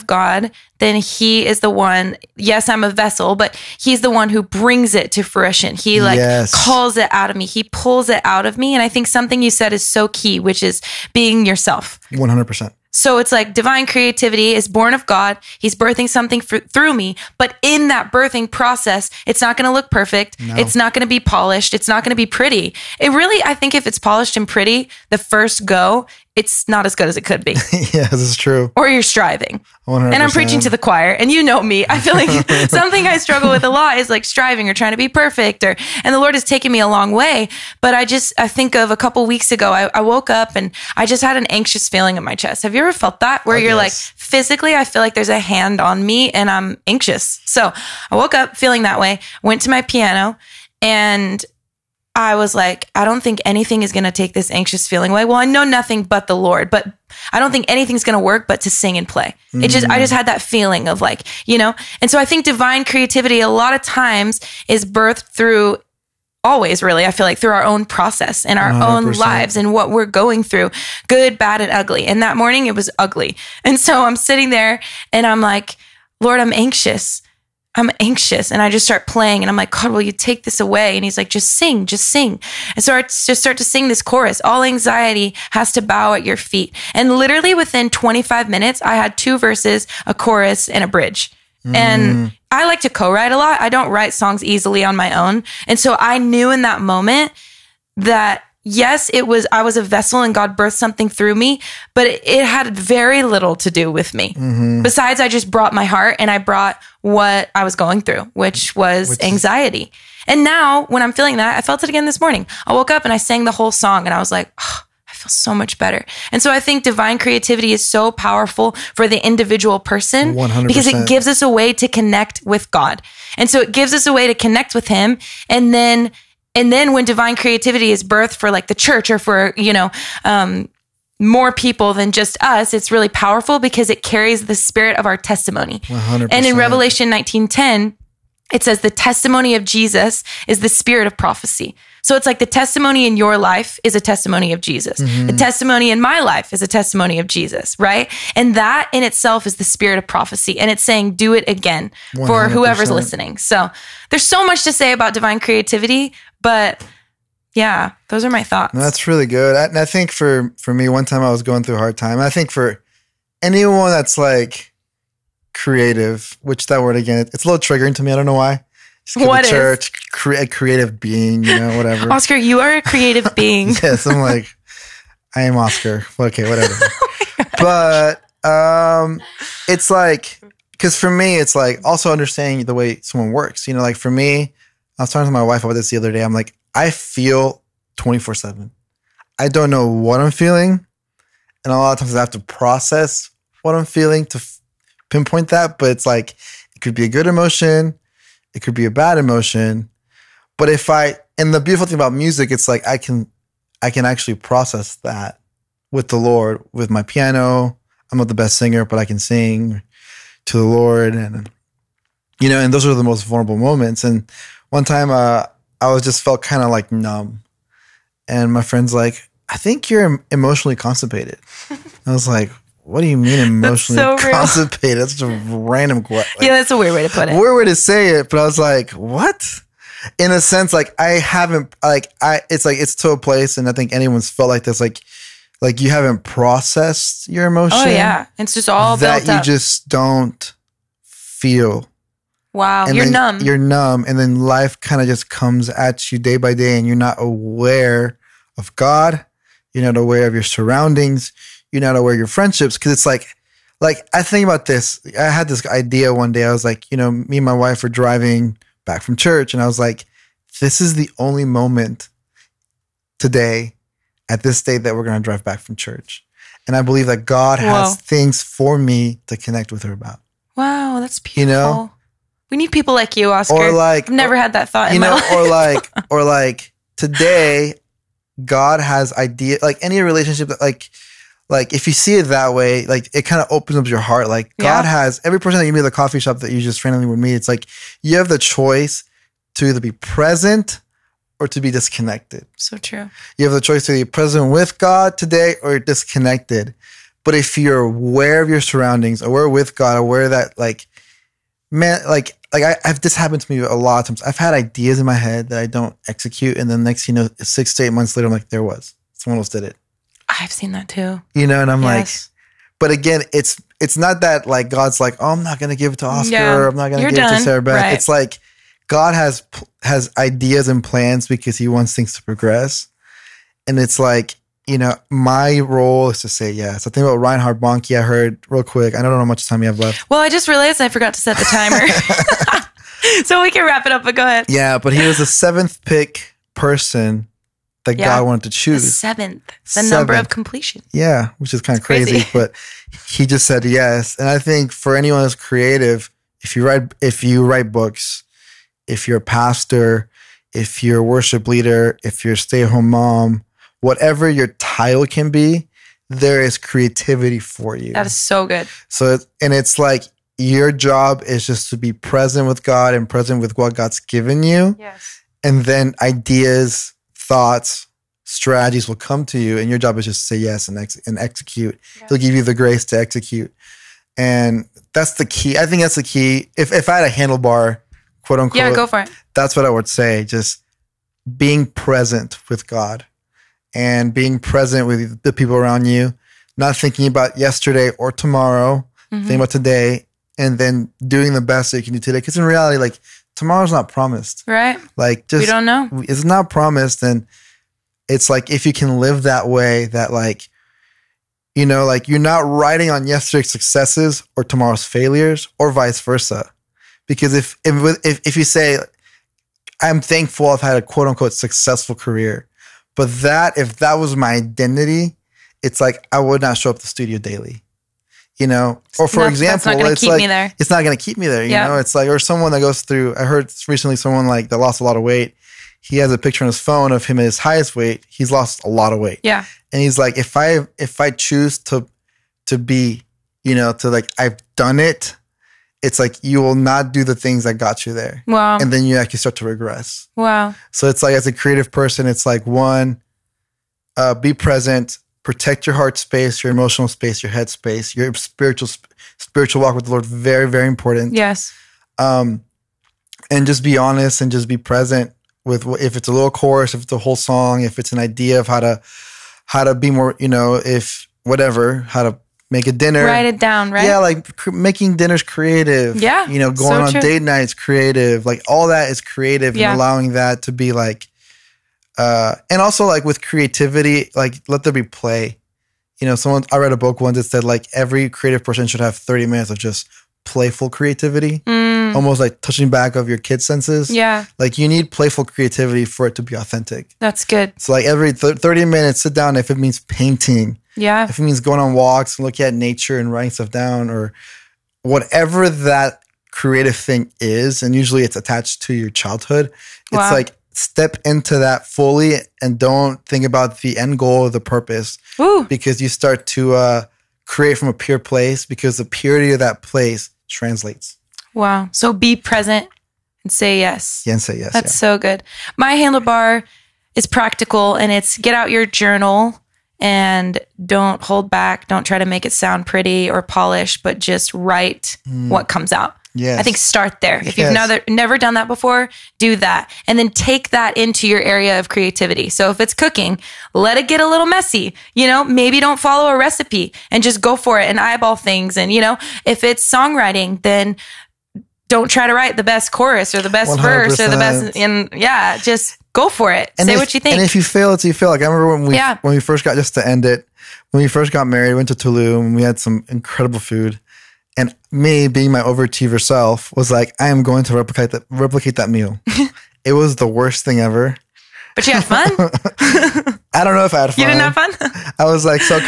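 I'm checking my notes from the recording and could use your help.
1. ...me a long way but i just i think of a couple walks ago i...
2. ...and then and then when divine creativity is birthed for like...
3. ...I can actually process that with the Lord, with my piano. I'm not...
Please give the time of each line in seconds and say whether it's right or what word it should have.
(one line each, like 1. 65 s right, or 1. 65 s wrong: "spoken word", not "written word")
1. 36 s wrong: "weeks", not "walks"
2. 125 s right
3. 203 s right.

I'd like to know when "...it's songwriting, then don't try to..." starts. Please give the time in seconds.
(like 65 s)
539 s.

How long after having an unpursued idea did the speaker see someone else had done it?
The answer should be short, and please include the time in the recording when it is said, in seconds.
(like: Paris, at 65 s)
6 to 8 months, at 307 s.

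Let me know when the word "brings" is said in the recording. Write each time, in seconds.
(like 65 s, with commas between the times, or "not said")
4 s.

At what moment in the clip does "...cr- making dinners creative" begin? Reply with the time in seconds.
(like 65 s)
464 s.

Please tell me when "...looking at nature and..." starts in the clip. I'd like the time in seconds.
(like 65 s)
492 s.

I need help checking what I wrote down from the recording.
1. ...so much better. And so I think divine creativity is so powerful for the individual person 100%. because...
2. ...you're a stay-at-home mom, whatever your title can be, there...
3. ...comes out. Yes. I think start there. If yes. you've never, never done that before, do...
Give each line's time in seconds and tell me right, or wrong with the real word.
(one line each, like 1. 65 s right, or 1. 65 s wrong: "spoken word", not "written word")
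1. 115 s right
2. 352 s right
3. 525 s right.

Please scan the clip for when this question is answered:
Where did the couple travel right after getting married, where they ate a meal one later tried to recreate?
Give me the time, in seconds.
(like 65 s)
551 s.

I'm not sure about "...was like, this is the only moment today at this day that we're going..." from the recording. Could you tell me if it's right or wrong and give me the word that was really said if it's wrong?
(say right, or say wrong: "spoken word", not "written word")
right.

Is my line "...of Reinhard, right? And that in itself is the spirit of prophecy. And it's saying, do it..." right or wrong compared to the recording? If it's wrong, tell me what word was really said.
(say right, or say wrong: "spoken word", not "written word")
wrong: "Jesus", not "Reinhard".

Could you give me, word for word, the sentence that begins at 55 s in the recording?
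Well, I know nothing but the Lord, but I don't think anything's going to work but to sing and play.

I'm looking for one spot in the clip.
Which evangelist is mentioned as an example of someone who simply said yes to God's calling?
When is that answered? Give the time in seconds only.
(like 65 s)
327 s.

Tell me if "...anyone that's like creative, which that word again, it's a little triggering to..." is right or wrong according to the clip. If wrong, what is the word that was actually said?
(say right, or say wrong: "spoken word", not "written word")
right.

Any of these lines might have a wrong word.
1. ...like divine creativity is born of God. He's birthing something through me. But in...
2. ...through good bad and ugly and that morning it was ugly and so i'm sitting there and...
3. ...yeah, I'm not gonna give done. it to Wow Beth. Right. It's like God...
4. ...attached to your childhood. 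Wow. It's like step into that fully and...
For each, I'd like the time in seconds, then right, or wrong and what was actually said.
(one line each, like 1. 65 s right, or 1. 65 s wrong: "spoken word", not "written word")
1. 13 s right
2. 70 s right
3. 316 s wrong: "Sarah", not "Wow"
4. 498 s right.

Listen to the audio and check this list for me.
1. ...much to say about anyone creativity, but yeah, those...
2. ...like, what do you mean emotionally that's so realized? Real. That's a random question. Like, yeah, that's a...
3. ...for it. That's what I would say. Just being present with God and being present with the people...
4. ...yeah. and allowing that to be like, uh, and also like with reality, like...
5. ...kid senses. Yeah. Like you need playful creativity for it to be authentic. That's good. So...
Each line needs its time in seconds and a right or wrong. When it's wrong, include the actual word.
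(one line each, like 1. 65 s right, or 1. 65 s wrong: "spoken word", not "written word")
1. 154 s wrong: "divine", not "anyone"
2. 222 s wrong: "constipated", not "realized"
3. 378 s right
4. 469 s wrong: "creativity", not "reality"
5. 483 s right.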